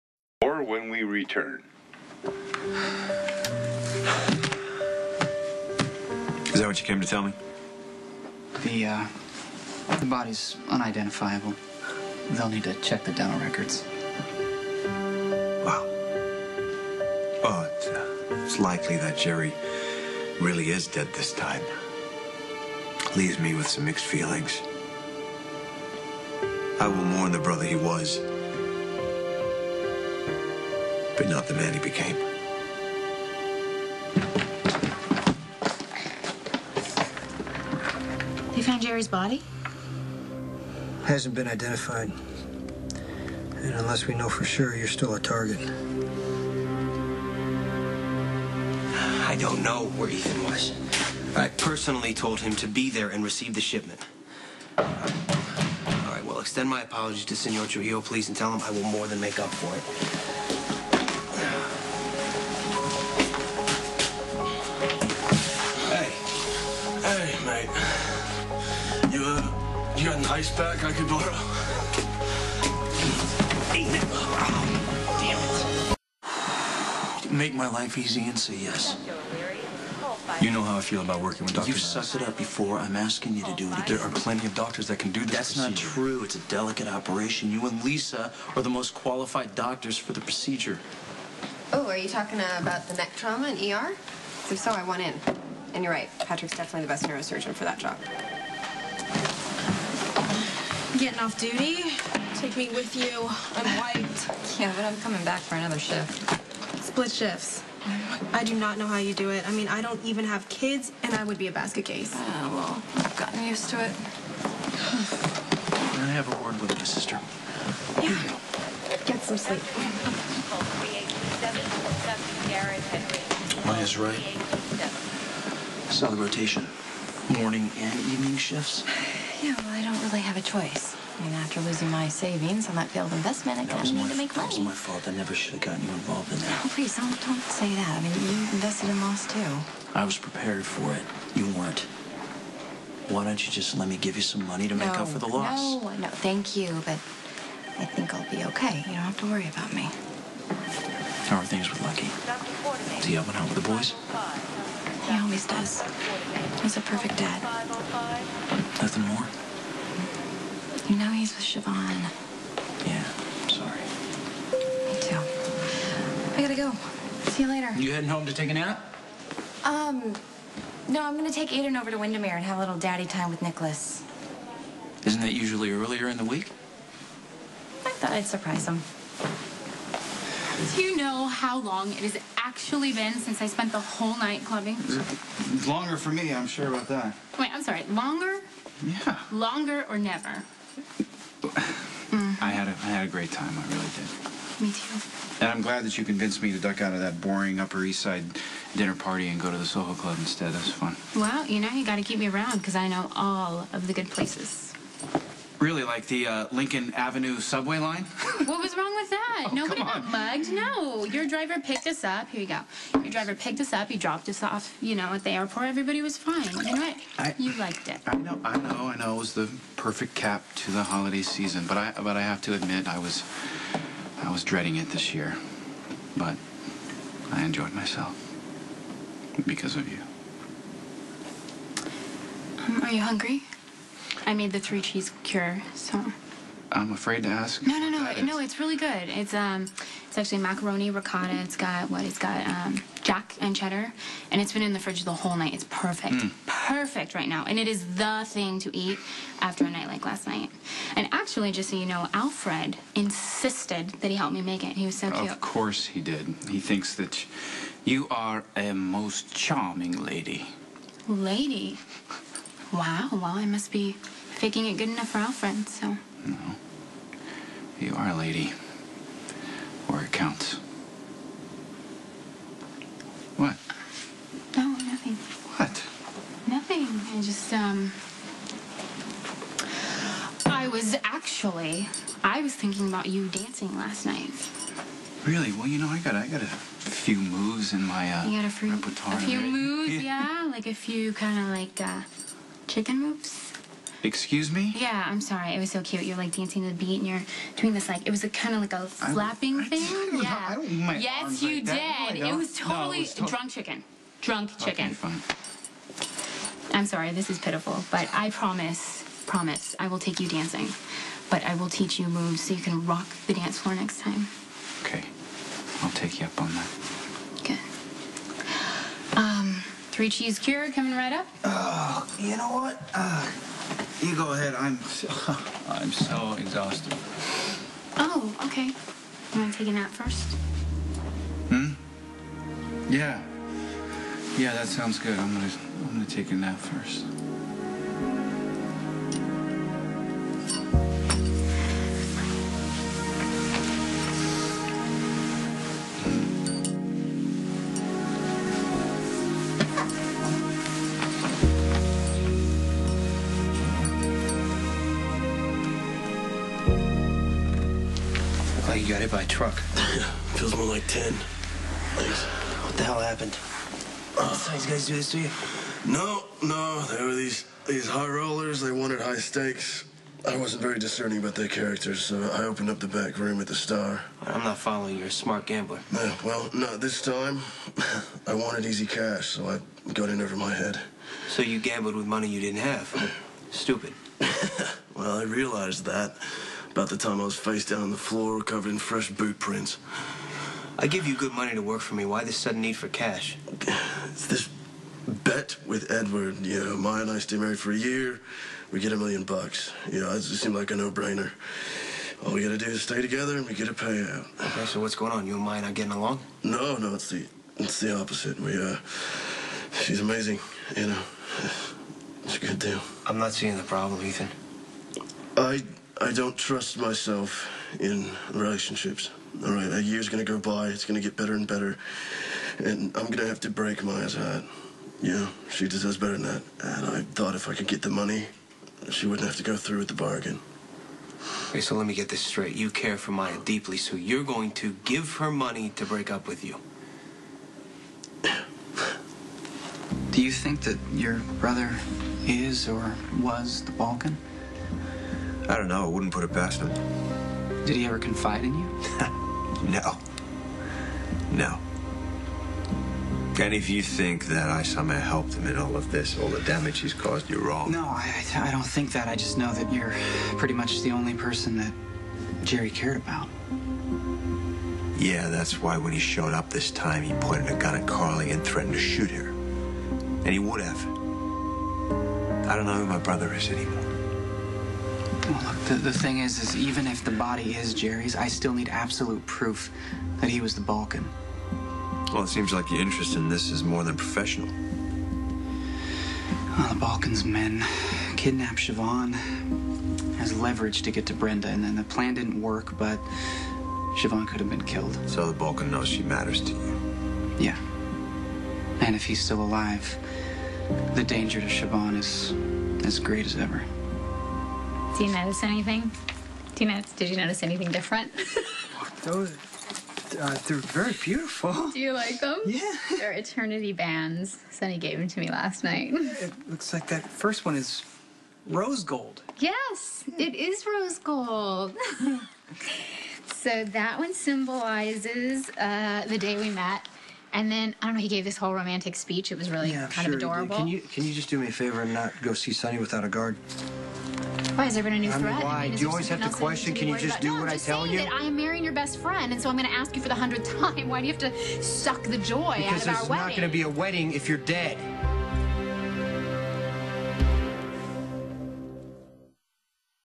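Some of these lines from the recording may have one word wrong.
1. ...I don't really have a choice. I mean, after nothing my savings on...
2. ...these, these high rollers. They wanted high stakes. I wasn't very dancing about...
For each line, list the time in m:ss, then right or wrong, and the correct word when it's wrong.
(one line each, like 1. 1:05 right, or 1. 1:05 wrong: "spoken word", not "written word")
1. 2:09 wrong: "losing", not "nothing"
2. 6:07 wrong: "discerning", not "dancing".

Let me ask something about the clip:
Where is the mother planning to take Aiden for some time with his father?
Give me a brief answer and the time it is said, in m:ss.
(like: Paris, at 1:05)
Wyndemere, at 2:51.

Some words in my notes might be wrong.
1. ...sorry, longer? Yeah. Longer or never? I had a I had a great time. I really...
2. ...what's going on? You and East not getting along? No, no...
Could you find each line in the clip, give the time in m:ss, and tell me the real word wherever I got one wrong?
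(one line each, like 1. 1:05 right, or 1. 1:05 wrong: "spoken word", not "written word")
1. 3:07 right
2. 6:44 wrong: "Maya", not "East".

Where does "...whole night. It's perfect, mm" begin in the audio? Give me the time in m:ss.
4:05.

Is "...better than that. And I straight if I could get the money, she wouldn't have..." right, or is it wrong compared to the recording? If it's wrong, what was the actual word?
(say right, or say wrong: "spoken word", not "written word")
wrong: "thought", not "straight".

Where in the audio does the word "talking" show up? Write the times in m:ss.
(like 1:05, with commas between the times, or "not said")
1:32.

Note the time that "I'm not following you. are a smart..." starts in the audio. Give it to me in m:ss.
6:14.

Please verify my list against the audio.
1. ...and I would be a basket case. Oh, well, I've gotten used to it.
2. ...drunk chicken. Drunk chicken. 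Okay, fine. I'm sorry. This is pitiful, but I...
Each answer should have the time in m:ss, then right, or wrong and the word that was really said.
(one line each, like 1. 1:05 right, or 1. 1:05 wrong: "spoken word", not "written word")
1. 1:51 right
2. 5:03 right.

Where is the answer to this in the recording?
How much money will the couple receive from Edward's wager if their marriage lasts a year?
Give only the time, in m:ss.
6:38.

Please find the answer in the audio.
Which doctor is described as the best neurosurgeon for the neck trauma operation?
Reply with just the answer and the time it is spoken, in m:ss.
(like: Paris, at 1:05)
Patrick, at 1:36.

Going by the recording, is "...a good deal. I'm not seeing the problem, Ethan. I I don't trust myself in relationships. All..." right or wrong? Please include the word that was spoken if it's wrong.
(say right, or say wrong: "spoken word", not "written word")
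right.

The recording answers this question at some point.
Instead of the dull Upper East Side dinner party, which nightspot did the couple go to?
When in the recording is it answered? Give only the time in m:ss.
3:19.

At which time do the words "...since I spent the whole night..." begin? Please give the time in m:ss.
3:03.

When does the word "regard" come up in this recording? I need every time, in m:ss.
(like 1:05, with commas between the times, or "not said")
not said.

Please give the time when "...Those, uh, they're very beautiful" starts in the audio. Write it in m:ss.
8:29.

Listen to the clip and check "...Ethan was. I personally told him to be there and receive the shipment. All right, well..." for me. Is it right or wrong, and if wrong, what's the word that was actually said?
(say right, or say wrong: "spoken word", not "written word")
right.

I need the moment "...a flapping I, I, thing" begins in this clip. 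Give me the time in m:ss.
4:58.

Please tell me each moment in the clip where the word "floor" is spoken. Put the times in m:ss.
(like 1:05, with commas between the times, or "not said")
5:13, 6:27.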